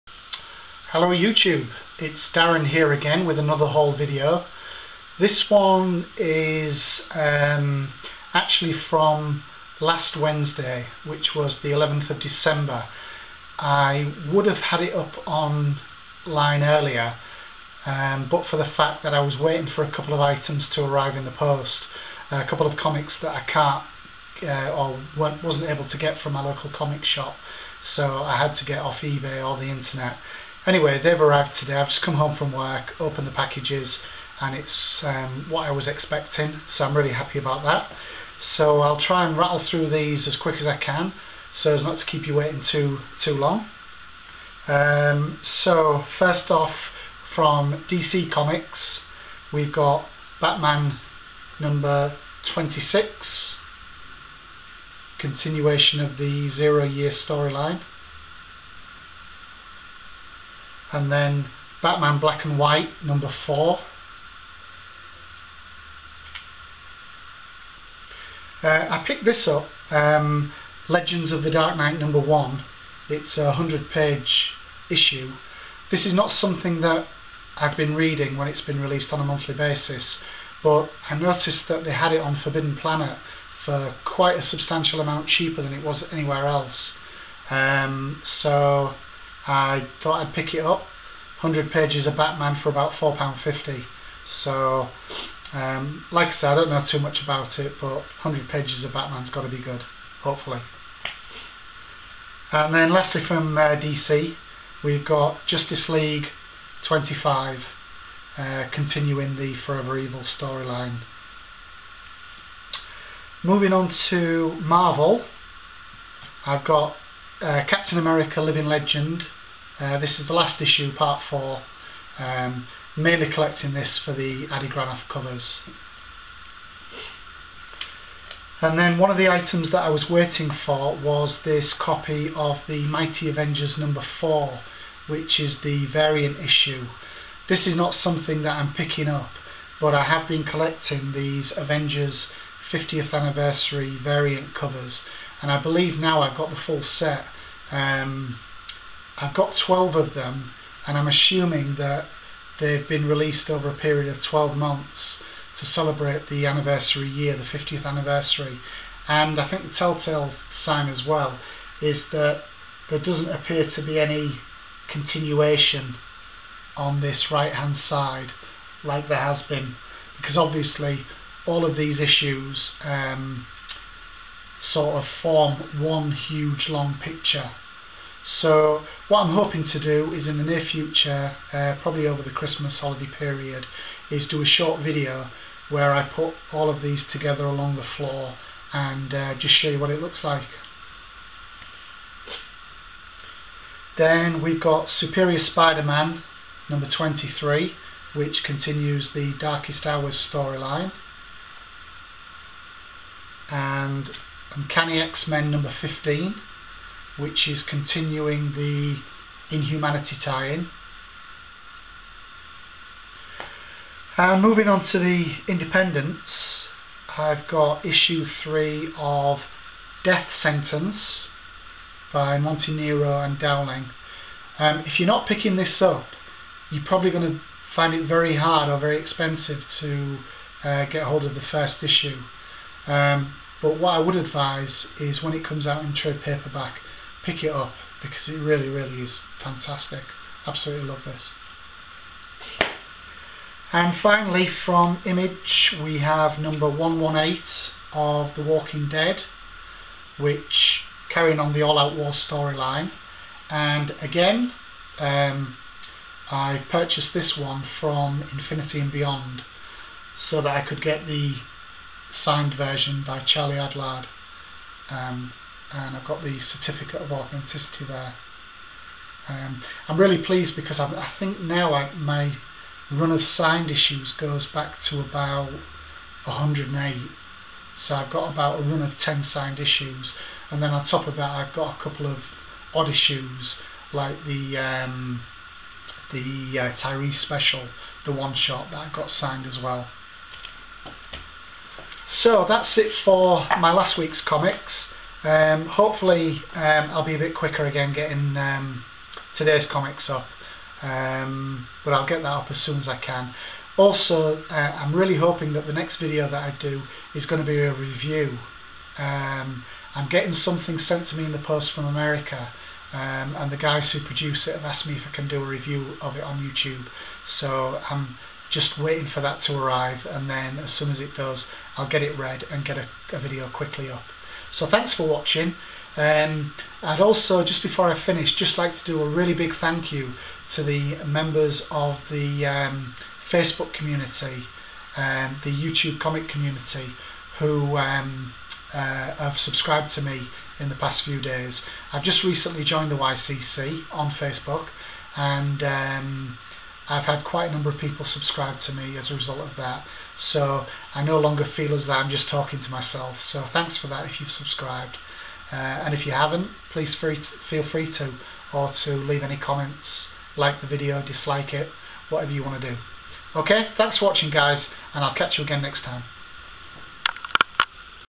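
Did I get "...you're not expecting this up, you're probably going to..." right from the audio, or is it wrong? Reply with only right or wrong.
wrong.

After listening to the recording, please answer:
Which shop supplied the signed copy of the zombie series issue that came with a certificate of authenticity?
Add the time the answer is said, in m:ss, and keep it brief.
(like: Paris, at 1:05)
Infinity and Beyond, at 4:18.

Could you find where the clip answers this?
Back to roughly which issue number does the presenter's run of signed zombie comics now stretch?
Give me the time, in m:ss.
4:36.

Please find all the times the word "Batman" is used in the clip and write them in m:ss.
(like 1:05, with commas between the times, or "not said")
0:50, 1:01, 1:32, 1:38.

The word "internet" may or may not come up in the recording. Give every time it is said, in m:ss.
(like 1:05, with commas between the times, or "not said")
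0:29.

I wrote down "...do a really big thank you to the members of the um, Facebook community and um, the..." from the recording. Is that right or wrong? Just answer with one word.
right.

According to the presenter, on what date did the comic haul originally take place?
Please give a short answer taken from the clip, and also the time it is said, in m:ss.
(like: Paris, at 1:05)
11th of December, at 0:11.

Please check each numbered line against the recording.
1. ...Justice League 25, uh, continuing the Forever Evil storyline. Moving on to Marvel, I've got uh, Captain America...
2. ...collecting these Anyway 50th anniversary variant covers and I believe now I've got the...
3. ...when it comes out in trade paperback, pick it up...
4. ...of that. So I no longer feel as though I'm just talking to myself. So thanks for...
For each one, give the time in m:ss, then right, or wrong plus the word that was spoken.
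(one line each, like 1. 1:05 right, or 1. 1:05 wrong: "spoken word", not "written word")
1. 1:45 right
2. 2:20 wrong: "Avengers", not "Anyway"
3. 3:55 right
4. 5:49 right.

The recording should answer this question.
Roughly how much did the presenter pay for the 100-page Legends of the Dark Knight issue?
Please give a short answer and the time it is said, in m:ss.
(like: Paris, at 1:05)
£4.50, at 1:32.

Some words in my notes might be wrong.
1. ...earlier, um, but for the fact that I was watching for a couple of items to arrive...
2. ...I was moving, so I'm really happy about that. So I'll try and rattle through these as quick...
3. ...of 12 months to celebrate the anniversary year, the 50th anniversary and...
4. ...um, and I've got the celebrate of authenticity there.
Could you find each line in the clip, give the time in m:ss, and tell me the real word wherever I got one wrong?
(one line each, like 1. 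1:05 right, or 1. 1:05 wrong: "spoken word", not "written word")
1. 0:16 wrong: "waiting", not "watching"
2. 0:35 wrong: "expecting", not "moving"
3. 2:34 right
4. 4:24 wrong: "certificate", not "celebrate".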